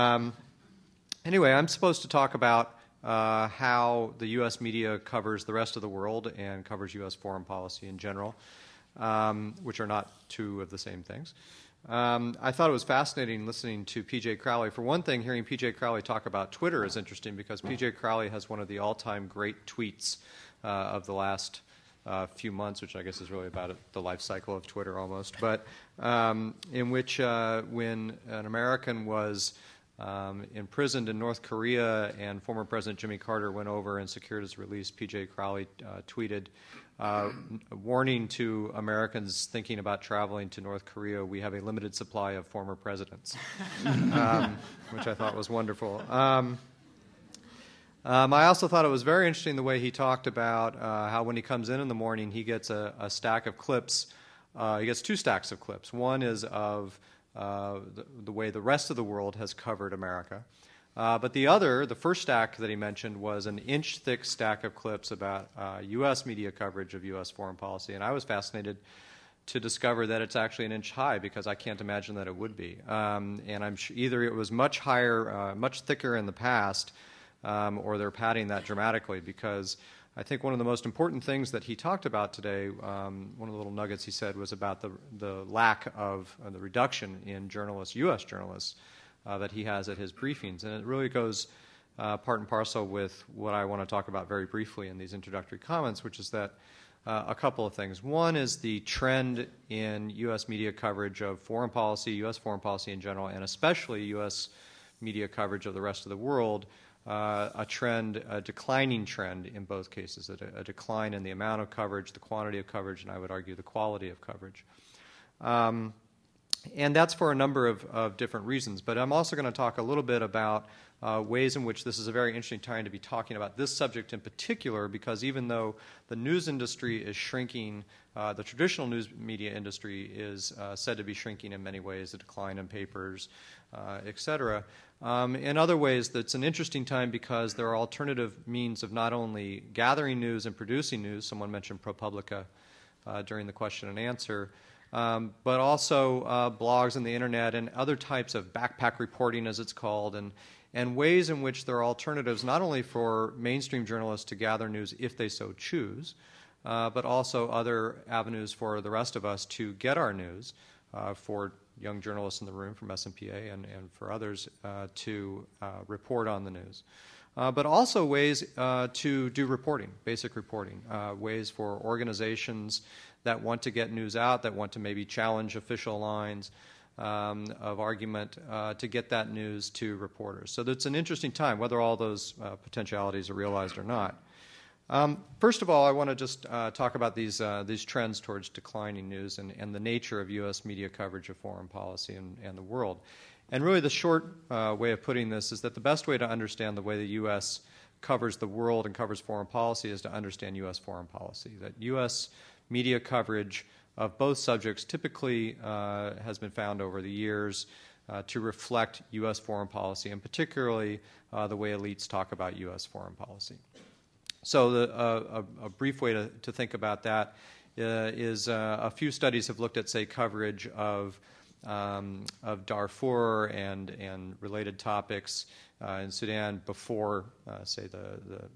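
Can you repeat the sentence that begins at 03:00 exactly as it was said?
So it's an interesting time, whether all those uh, potentialities are realized or not.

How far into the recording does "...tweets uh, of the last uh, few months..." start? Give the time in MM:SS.
00:19.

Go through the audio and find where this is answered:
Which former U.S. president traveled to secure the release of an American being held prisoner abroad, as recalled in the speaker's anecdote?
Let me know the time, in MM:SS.
00:32.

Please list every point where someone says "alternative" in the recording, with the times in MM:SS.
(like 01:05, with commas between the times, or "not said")
02:17, 02:31.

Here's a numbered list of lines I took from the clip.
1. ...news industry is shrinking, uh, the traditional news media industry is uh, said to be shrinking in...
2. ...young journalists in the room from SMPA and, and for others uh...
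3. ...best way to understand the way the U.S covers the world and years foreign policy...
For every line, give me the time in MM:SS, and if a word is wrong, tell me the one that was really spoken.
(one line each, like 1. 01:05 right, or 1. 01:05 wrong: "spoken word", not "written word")
1. 02:06 right
2. 02:41 right
3. 03:15 wrong: "covers", not "years".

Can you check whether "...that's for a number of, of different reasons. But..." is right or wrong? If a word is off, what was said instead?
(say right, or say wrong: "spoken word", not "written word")
right.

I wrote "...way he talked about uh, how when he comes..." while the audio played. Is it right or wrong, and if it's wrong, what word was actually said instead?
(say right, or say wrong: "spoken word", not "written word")
right.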